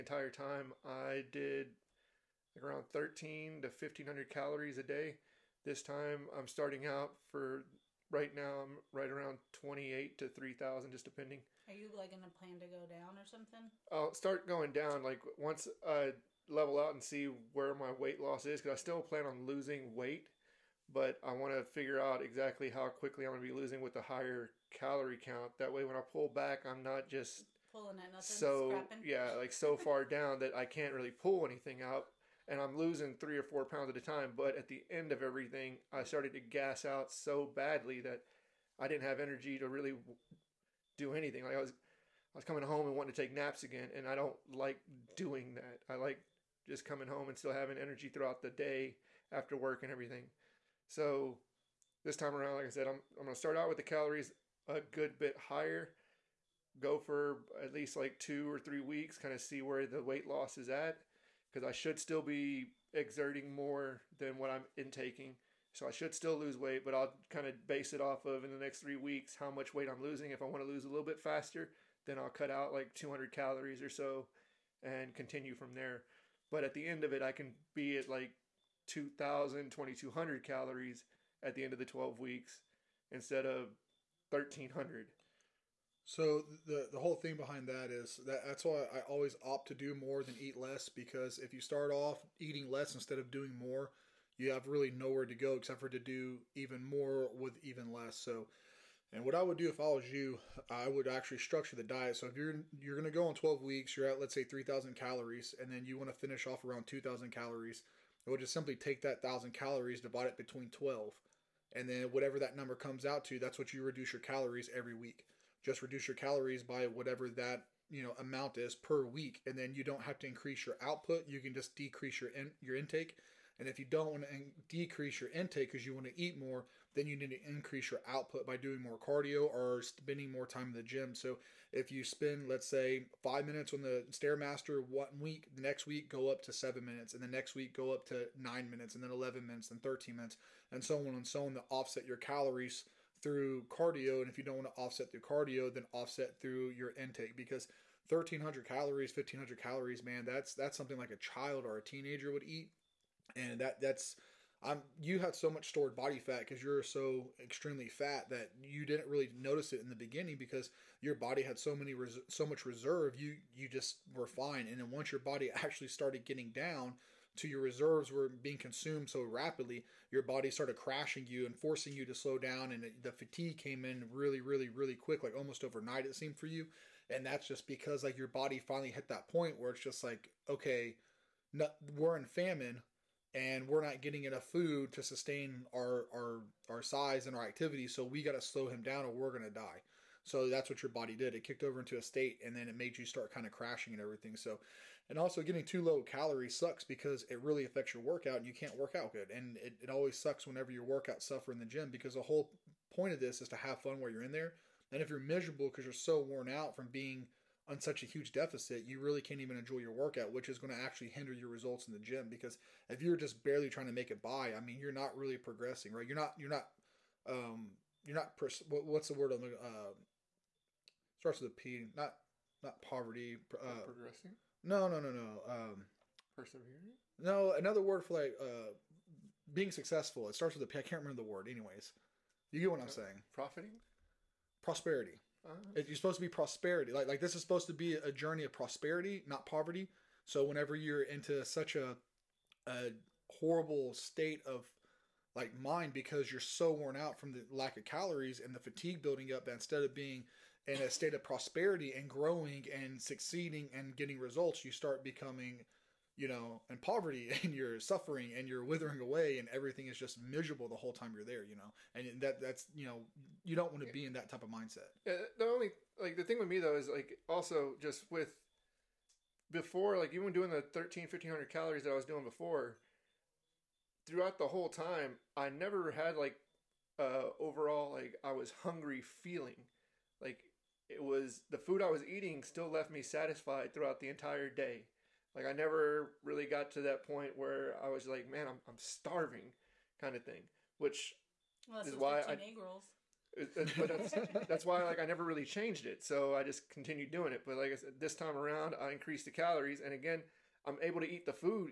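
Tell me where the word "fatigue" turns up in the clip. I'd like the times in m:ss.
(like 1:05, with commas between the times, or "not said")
2:53, 4:08.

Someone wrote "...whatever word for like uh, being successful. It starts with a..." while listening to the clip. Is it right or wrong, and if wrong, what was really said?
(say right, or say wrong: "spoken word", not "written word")
wrong: "another", not "whatever".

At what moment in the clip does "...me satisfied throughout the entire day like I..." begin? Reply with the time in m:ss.
4:42.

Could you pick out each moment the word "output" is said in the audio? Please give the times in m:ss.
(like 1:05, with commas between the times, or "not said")
2:00, 2:08.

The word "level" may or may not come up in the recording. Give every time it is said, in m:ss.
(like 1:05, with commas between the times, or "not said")
0:16.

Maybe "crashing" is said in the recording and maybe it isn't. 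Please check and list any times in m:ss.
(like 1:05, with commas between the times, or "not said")
2:50, 3:13.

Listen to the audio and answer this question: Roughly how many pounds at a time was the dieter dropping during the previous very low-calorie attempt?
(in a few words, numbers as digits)
3 or 4.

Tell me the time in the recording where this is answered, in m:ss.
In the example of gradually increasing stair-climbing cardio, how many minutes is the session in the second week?
2:16.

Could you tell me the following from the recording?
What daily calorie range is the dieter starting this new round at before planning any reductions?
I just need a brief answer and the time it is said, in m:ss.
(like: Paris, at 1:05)
2800 to 3000, at 0:09.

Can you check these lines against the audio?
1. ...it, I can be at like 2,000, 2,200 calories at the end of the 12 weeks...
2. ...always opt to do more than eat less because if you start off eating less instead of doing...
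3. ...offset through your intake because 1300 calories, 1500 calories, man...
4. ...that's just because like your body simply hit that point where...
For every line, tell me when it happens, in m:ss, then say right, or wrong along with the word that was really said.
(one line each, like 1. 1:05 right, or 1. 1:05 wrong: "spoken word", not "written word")
1. 1:17 right
2. 1:29 right
3. 2:25 right
4. 2:57 wrong: "finally", not "simply".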